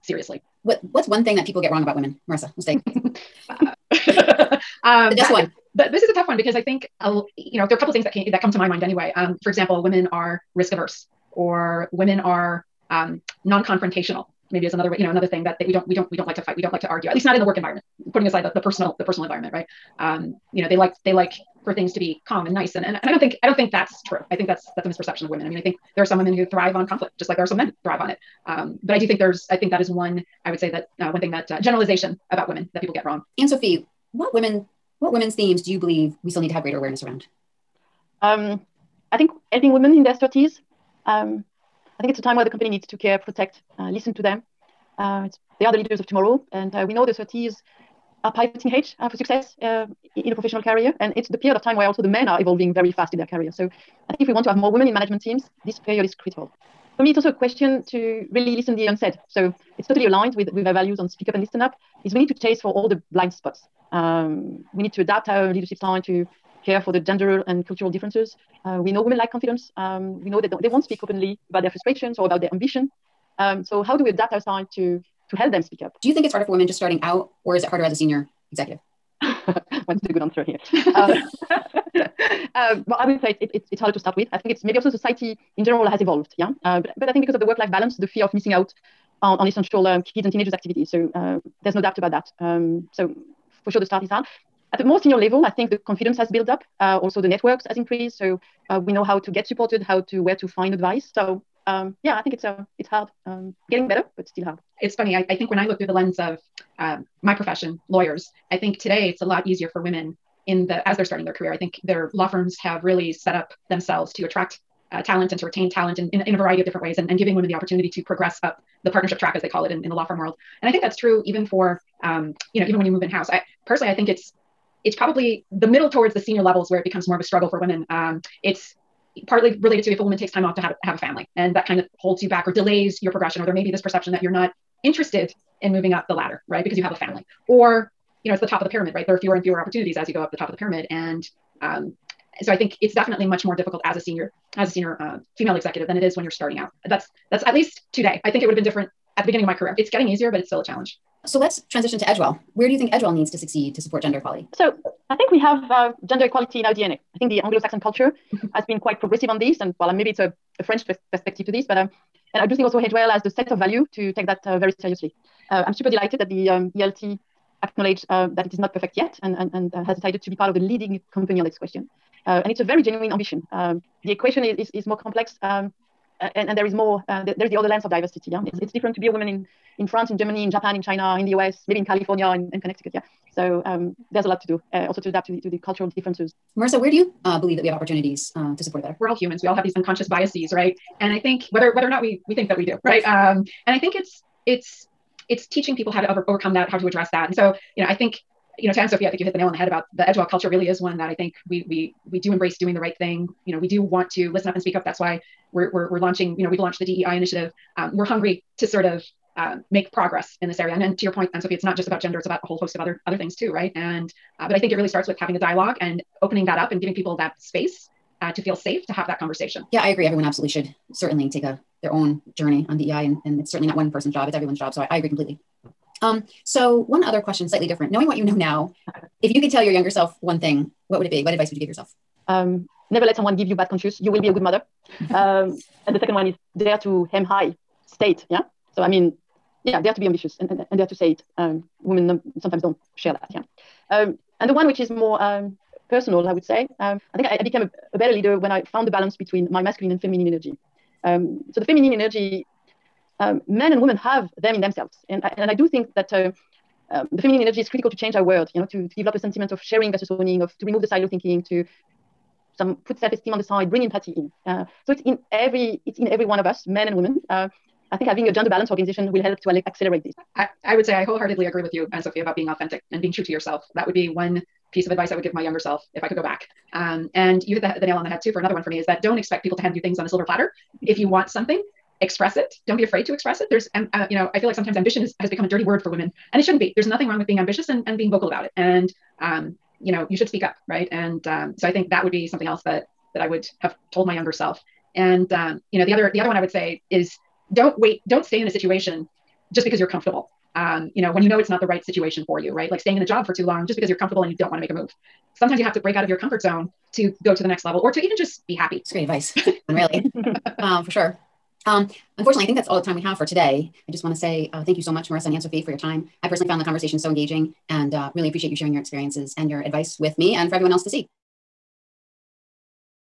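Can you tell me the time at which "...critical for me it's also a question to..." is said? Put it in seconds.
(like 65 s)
56 s.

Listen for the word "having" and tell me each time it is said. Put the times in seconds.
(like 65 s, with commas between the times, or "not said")
215 s, 268 s.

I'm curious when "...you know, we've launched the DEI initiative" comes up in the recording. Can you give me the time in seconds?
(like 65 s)
206 s.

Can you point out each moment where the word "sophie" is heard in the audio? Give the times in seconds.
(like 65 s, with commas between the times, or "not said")
33 s, 198 s, 211 s, 272 s, 315 s.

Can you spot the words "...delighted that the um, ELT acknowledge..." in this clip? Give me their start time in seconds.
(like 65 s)
165 s.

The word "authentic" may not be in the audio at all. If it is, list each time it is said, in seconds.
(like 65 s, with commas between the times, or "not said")
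272 s.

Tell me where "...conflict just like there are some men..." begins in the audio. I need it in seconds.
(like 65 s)
26 s.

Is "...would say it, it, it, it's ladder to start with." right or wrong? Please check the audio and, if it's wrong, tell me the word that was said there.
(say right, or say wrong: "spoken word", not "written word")
wrong: "harder", not "ladder".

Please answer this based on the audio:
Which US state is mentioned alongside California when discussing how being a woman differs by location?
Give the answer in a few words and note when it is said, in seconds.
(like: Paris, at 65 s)
Connecticut, at 182 s.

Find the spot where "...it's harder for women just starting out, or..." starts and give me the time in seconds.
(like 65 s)
76 s.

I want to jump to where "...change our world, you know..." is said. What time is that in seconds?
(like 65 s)
257 s.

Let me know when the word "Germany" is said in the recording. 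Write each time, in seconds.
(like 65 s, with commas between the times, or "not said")
180 s.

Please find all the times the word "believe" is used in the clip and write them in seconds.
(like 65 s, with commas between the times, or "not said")
35 s, 187 s.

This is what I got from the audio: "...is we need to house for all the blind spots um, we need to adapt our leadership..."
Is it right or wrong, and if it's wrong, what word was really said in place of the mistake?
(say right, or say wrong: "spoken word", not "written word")
wrong: "chase", not "house".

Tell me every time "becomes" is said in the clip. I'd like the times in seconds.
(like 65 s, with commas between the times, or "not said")
126 s, 285 s.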